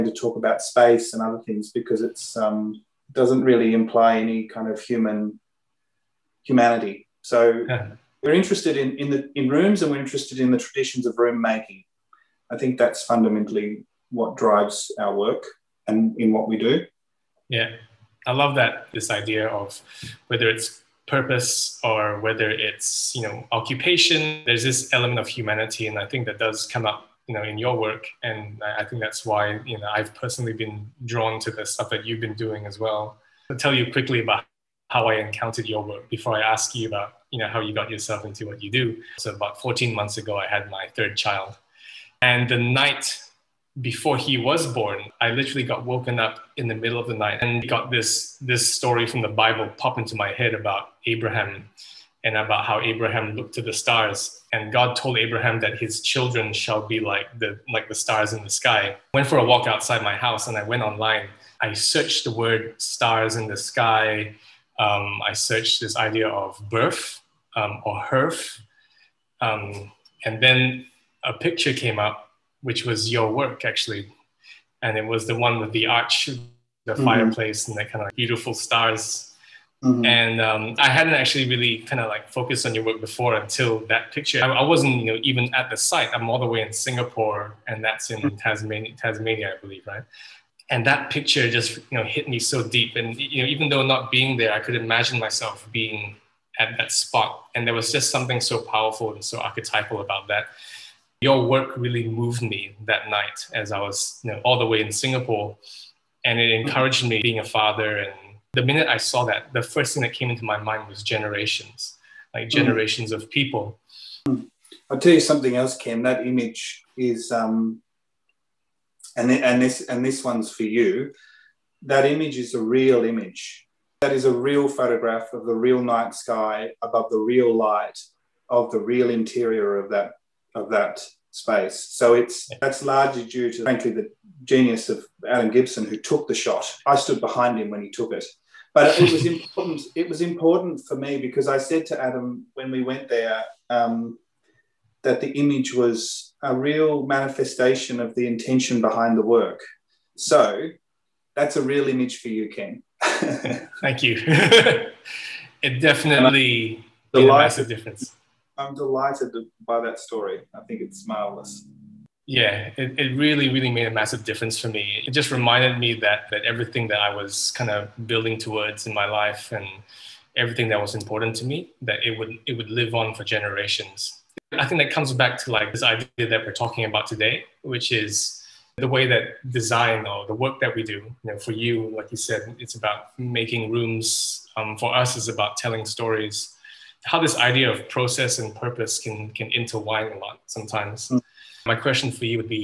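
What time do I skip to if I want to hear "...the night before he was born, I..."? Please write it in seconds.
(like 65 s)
42 s.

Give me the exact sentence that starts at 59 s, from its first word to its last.
Went for a walk outside my house and I went online.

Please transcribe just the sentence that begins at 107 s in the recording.
And the minute I saw that, the first thing that came into my mind was generations, like mm.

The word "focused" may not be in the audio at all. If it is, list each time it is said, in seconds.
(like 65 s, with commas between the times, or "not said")
82 s.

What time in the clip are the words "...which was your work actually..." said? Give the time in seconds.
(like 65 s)
72 s.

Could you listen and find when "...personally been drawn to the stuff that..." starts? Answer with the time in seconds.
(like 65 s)
30 s.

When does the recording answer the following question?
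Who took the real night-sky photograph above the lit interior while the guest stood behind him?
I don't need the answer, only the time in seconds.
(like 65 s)
135 s.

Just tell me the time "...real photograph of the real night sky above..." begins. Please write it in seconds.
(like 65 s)
124 s.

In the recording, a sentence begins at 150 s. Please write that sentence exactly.
So that's a real image for you, Ken.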